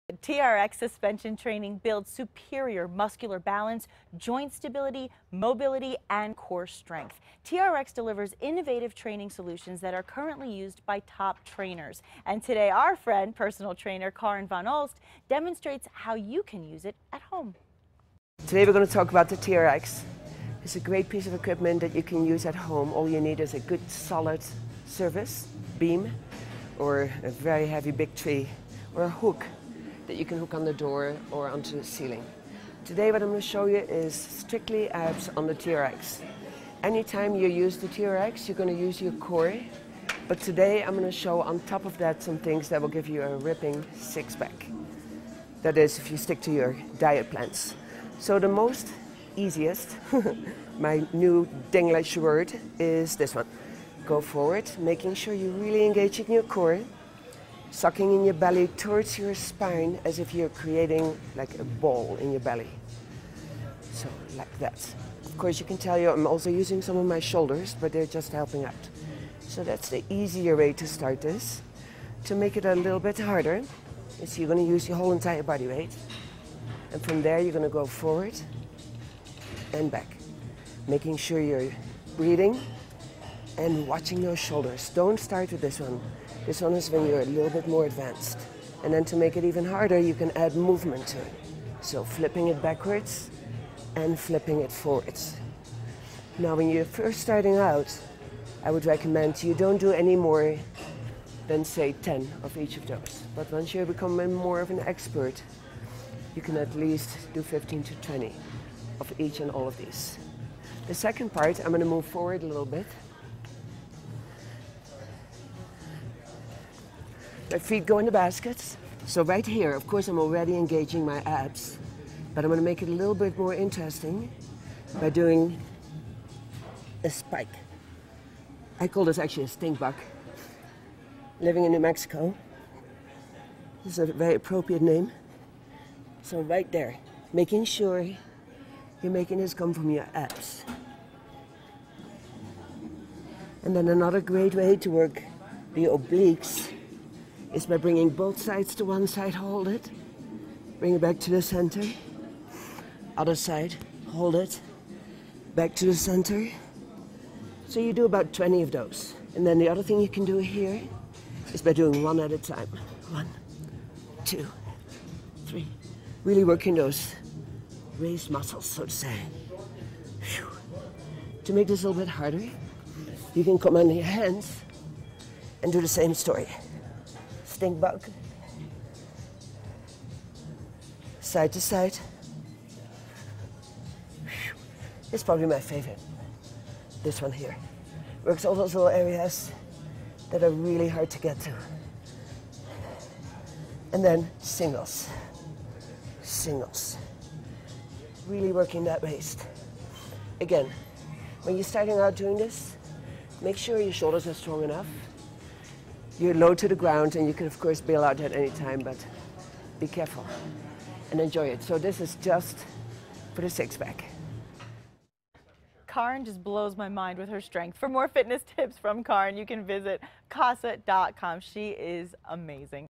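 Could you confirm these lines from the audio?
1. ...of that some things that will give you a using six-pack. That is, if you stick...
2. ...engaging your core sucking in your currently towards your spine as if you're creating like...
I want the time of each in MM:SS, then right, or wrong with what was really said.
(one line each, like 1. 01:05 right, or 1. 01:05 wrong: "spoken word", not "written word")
1. 00:41 wrong: "ripping", not "using"
2. 00:55 wrong: "belly", not "currently".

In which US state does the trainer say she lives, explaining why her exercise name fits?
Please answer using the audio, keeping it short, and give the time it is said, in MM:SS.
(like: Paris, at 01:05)
New Mexico, at 02:11.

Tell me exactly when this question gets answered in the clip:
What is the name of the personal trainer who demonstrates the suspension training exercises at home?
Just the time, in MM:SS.
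00:14.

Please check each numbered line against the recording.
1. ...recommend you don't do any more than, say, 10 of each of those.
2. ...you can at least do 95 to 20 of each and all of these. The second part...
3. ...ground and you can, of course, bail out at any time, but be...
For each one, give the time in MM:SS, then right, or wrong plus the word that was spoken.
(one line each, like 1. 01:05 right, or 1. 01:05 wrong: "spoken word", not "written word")
1. 01:38 right
2. 01:46 wrong: "15", not "95"
3. 03:26 right.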